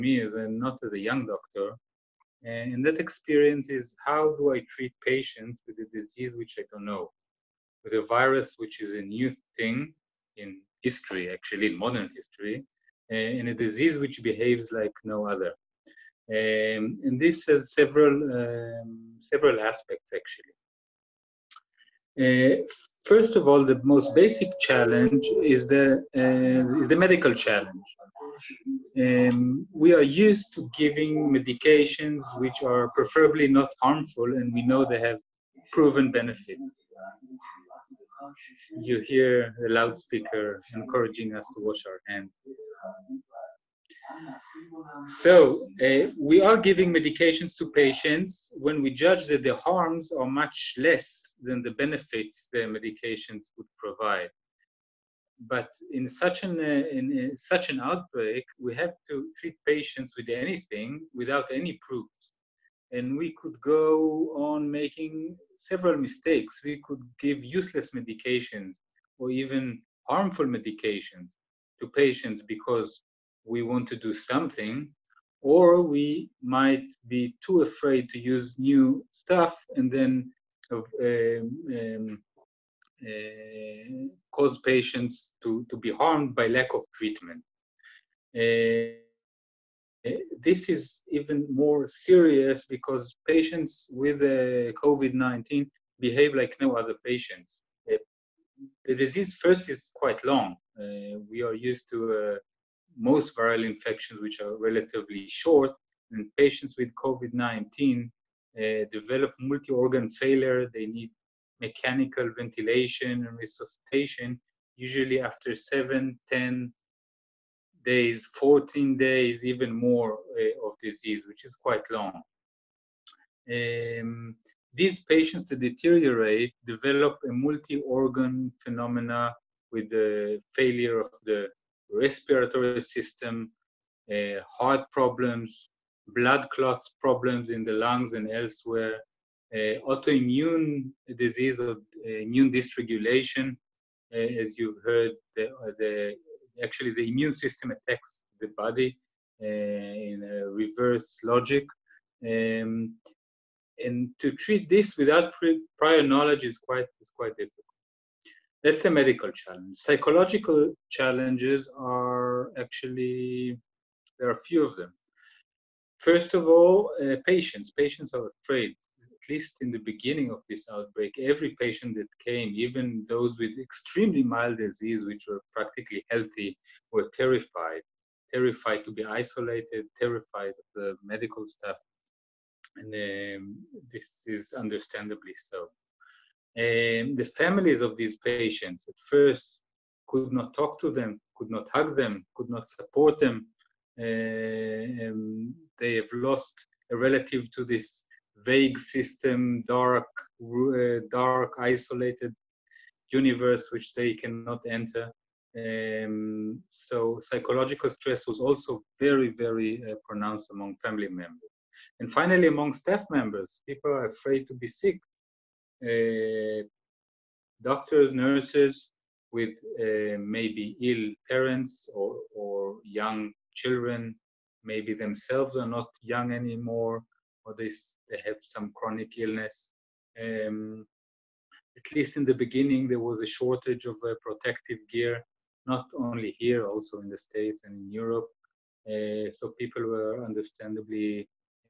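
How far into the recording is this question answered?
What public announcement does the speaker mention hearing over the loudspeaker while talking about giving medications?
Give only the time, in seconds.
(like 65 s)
41 s.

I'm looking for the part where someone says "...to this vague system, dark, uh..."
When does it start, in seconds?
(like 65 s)
197 s.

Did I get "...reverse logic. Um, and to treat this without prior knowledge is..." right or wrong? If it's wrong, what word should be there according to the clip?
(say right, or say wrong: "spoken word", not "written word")
right.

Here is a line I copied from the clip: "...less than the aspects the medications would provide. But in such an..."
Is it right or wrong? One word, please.
wrong.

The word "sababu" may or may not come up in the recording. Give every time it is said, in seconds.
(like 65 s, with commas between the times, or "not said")
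not said.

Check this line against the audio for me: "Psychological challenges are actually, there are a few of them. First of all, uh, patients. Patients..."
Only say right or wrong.
right.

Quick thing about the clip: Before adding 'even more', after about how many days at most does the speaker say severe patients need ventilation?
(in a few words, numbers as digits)
14 days.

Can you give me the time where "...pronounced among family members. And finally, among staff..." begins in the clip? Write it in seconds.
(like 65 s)
210 s.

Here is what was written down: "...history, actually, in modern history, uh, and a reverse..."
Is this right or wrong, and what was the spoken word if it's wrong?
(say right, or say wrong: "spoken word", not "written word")
wrong: "disease", not "reverse".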